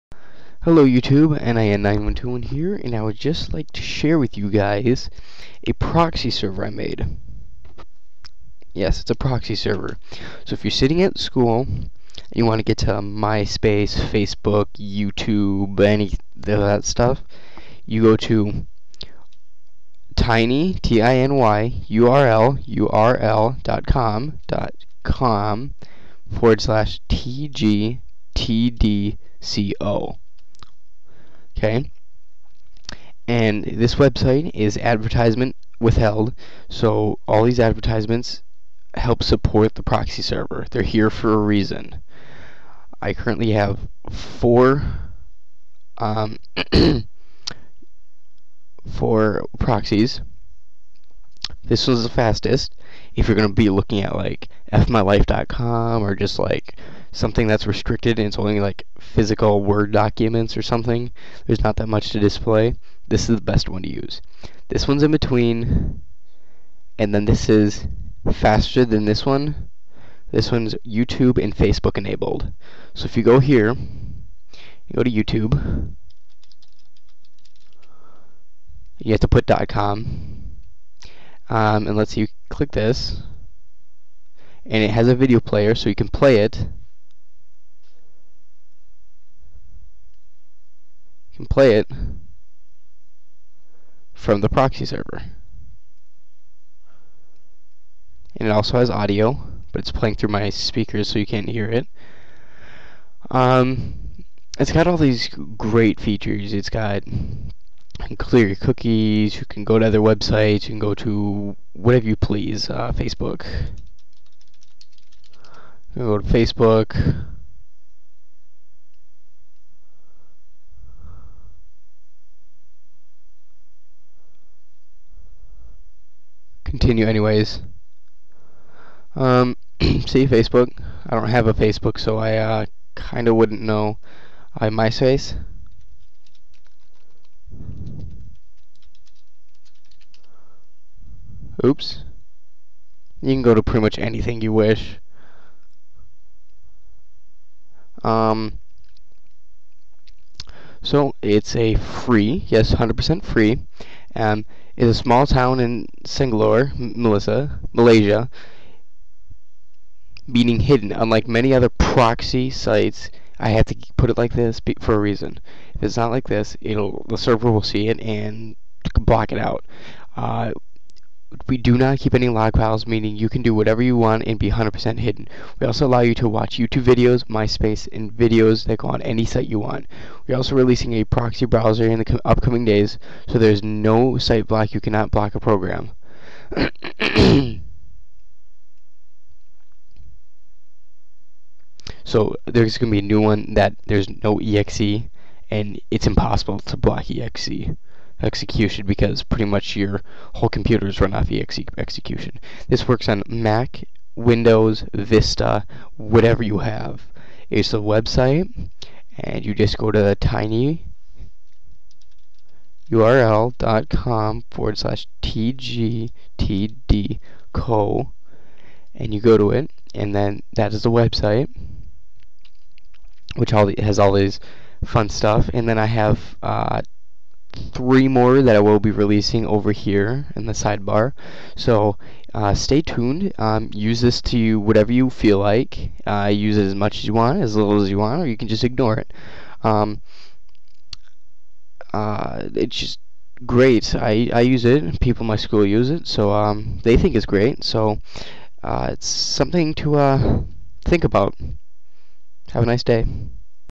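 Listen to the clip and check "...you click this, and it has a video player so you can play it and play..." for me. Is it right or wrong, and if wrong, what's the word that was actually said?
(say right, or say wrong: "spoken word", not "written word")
right.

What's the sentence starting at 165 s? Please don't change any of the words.
If it's not like this, it'll the server will see it and block it out.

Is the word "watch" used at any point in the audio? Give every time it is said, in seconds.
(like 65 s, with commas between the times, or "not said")
176 s.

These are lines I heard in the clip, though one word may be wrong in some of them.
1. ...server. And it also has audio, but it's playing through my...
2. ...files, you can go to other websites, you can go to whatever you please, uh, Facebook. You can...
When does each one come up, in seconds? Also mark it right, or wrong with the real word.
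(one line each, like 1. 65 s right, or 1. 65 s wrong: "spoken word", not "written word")
1. 94 s right
2. 108 s wrong: "cookies", not "files".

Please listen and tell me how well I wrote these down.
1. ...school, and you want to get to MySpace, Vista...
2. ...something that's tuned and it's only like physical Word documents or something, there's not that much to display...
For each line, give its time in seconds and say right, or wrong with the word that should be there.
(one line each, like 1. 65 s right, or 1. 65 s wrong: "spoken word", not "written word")
1. 11 s wrong: "Facebook", not "Vista"
2. 57 s wrong: "restricted", not "tuned".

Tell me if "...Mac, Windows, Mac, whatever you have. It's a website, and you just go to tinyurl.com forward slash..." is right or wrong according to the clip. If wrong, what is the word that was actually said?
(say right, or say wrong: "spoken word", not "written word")
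wrong: "Vista", not "Mac".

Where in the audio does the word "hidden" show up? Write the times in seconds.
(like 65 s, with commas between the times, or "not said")
160 s, 174 s.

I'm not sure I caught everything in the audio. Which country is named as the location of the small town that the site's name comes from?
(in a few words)
Malaysia.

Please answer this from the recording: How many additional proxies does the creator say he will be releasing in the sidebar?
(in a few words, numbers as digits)
3.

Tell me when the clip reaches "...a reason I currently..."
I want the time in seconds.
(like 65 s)
41 s.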